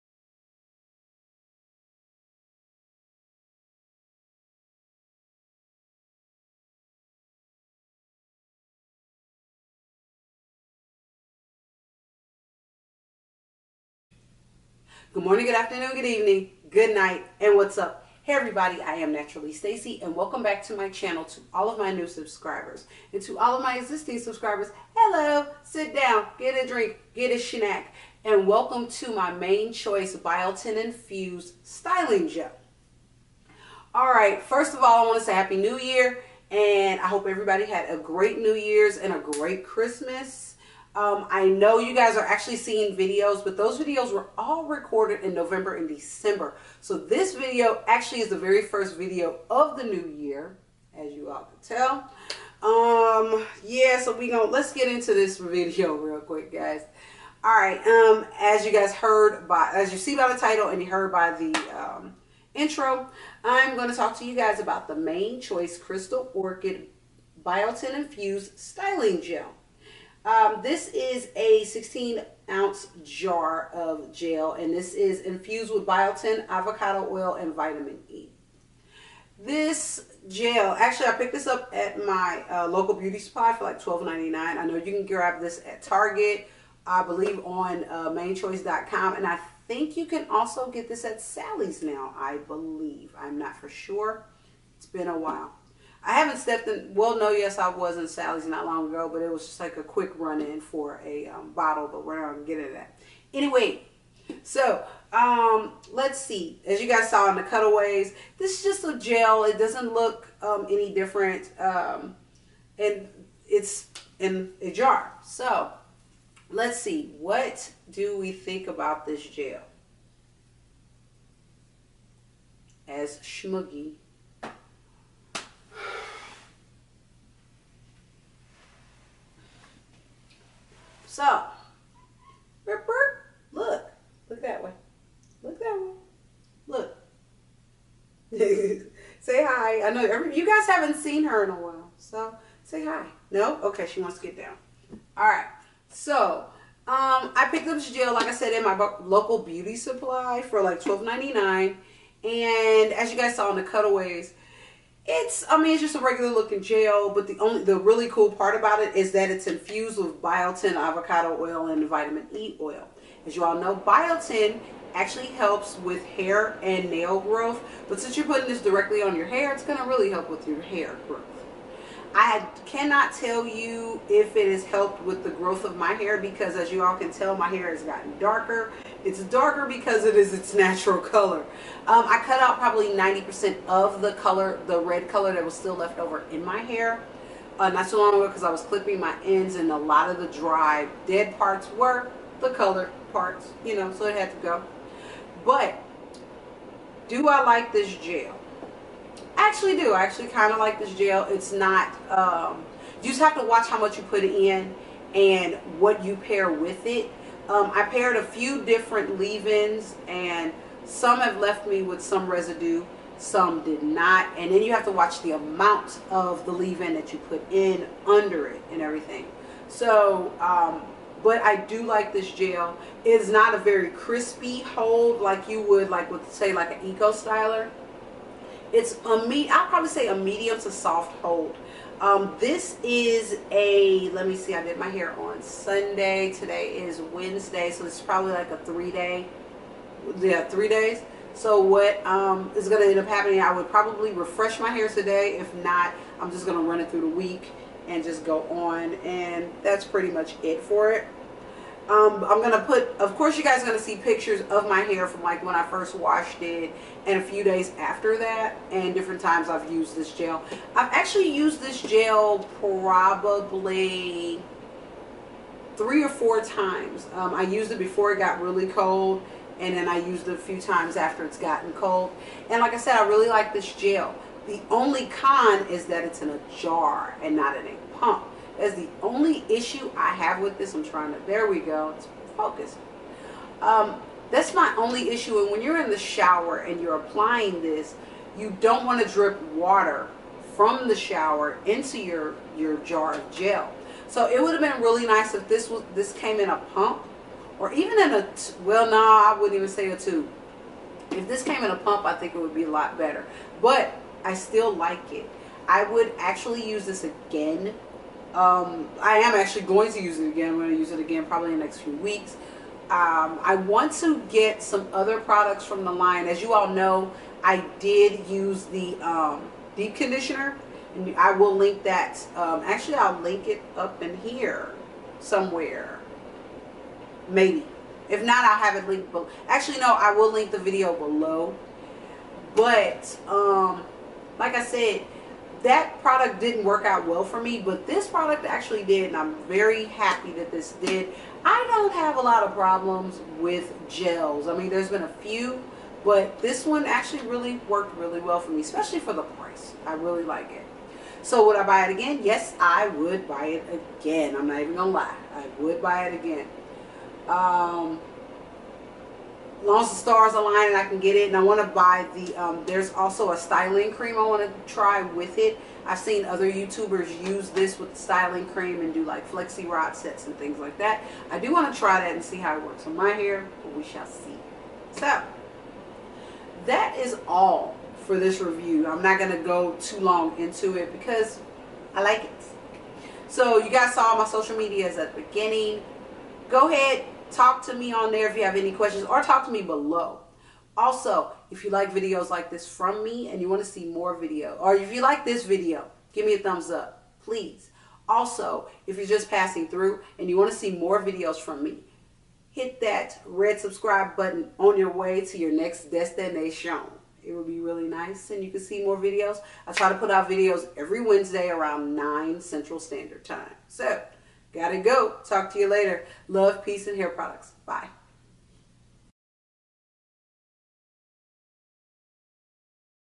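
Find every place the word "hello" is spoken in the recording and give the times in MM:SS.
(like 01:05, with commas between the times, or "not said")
00:24.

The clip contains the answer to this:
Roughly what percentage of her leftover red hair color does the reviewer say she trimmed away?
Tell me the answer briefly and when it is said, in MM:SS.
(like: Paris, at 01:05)
90%, at 03:02.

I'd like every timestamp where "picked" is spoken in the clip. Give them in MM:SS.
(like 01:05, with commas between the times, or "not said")
01:21, 02:27.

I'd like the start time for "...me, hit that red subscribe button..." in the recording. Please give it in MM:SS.
06:41.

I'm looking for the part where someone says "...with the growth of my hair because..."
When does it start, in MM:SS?
02:55.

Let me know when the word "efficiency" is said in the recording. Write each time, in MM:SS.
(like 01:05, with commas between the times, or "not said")
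not said.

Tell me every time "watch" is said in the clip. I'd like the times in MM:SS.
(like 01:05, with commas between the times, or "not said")
03:23, 03:34.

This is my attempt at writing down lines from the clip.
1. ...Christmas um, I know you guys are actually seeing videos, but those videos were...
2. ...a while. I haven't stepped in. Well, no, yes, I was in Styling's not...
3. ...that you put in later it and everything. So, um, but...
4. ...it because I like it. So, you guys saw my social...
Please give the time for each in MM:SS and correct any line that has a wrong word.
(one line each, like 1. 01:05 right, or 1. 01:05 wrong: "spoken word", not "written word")
1. 00:39 right
2. 01:35 wrong: "Sally", not "Styling"
3. 03:36 wrong: "under", not "later"
4. 06:20 right.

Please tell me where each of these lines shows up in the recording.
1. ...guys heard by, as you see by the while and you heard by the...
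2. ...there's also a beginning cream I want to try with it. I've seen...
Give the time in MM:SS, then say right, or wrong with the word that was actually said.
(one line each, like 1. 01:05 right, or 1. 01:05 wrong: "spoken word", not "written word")
1. 00:58 wrong: "title", not "while"
2. 06:02 wrong: "styling", not "beginning".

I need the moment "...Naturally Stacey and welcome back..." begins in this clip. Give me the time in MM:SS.
00:19.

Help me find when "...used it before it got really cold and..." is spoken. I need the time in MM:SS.
04:27.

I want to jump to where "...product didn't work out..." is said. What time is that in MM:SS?
05:36.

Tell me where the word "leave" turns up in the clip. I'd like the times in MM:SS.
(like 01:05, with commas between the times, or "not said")
03:29, 03:36.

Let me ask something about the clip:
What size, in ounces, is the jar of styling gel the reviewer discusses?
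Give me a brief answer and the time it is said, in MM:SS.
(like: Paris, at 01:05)
16 ounces, at 01:11.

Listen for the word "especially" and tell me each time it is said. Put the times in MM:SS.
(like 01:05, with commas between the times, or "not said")
05:48.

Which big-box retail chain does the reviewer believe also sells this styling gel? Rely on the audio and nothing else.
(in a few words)
Target.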